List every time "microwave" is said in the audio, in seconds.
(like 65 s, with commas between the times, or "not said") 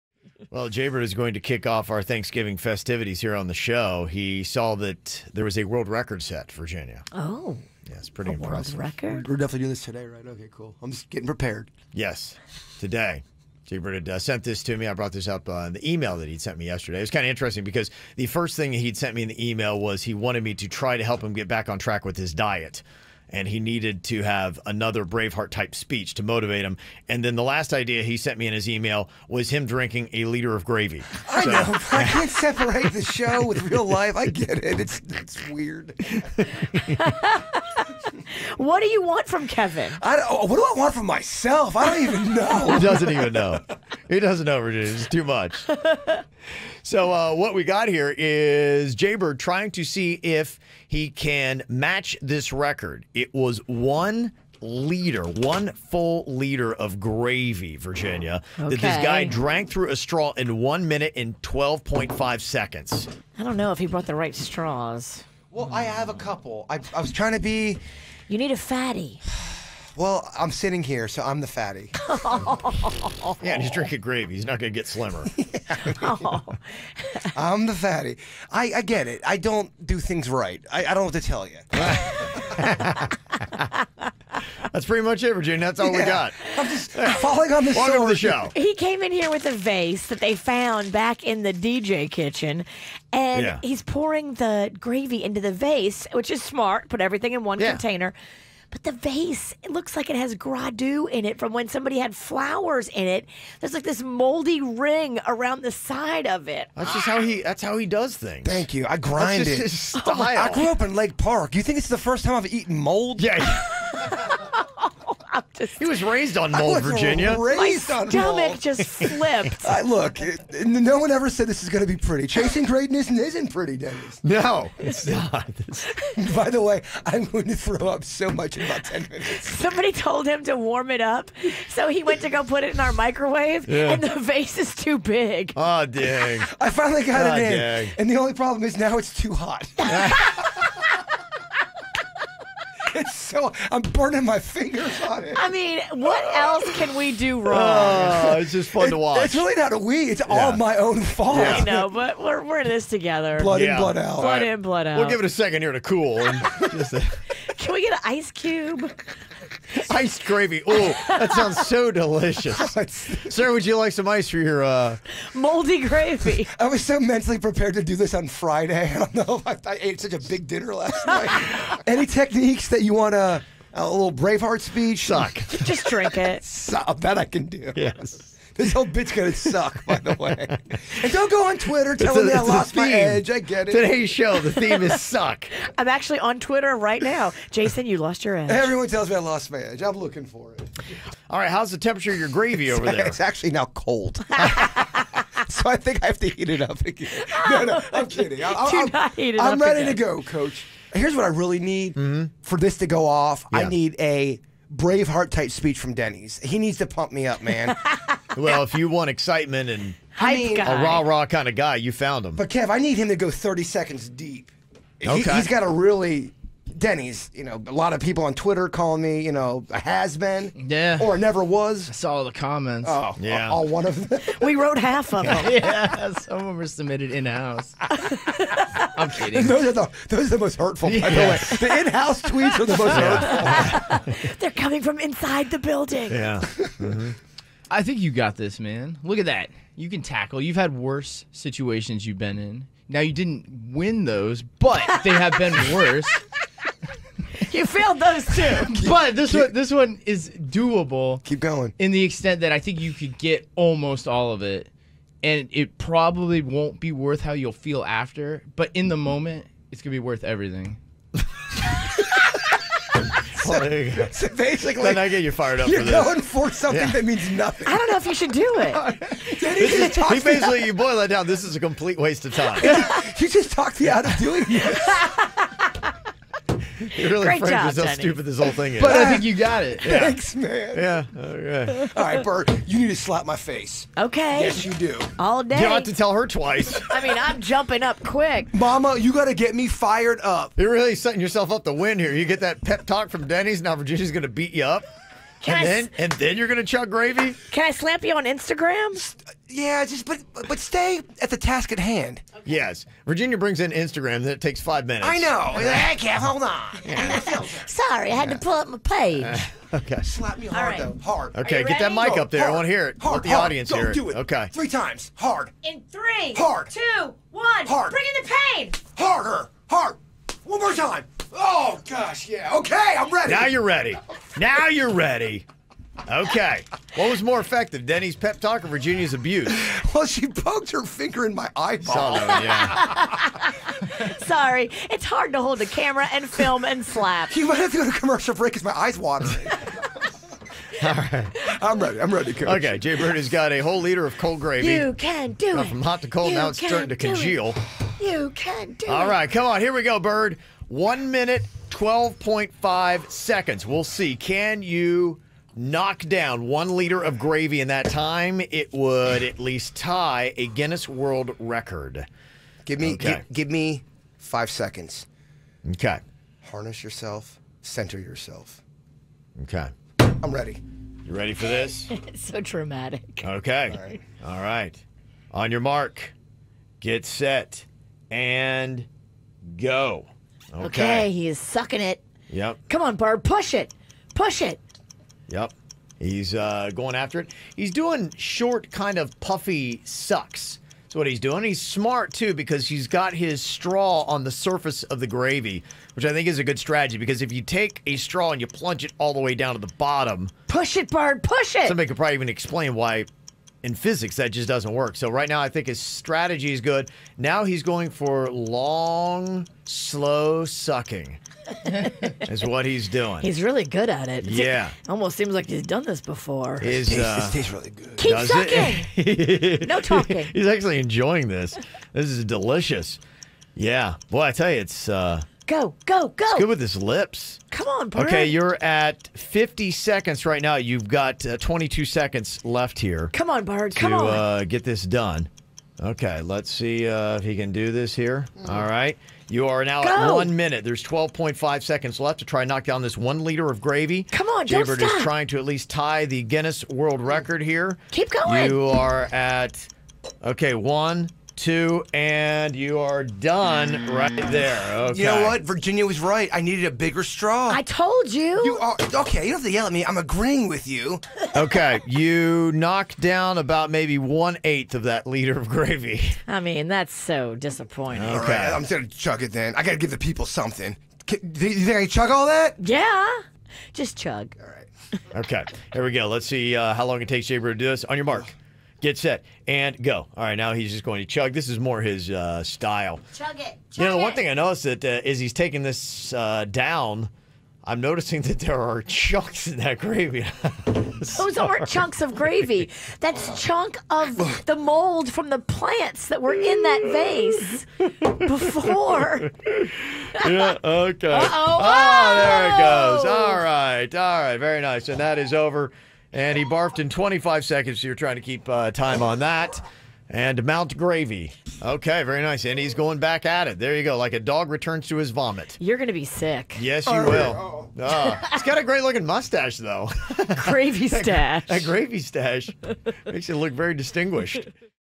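132 s.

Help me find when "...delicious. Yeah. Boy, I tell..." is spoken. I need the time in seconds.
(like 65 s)
422 s.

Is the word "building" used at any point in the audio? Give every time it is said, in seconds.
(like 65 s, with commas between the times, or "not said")
235 s.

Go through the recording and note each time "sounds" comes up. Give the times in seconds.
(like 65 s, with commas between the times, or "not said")
161 s.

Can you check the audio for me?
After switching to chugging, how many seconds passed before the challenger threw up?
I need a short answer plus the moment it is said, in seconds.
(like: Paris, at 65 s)
25, at 506 s.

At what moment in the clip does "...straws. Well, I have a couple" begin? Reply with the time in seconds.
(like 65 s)
64 s.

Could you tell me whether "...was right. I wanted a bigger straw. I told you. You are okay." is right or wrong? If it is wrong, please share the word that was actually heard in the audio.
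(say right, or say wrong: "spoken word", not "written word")
wrong: "needed", not "wanted".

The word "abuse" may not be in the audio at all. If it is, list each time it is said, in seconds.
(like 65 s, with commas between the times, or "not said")
329 s.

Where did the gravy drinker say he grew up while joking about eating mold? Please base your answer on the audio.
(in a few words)
Lake Park.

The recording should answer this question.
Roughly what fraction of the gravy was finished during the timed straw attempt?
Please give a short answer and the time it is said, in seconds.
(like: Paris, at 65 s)
one eighth, at 463 s.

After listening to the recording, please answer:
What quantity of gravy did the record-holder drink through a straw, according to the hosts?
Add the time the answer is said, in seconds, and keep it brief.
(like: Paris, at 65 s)
1 liter, at 55 s.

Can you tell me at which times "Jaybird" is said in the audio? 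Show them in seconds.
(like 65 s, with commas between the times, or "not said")
0 s, 13 s, 48 s, 444 s.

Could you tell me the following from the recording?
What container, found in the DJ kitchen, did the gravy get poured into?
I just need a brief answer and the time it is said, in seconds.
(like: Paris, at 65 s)
a vase, at 89 s.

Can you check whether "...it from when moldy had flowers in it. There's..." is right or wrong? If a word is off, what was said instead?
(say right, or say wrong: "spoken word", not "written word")
wrong: "somebody", not "moldy".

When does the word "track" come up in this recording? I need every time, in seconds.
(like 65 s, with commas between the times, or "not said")
21 s.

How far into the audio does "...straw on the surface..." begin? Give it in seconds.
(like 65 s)
393 s.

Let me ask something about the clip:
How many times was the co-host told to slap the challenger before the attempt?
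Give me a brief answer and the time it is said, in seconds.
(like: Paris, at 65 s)
3, at 314 s.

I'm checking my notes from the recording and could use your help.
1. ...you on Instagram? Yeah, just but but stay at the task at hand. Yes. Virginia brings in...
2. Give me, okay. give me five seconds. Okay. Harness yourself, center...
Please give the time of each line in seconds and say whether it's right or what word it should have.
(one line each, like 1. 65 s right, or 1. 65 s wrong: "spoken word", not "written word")
1. 298 s right
2. 362 s right.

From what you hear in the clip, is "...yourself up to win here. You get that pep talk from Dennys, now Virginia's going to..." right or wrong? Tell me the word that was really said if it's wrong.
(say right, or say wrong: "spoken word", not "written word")
right.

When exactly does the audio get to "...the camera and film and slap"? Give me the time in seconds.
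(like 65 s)
335 s.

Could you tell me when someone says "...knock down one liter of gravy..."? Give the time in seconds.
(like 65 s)
355 s.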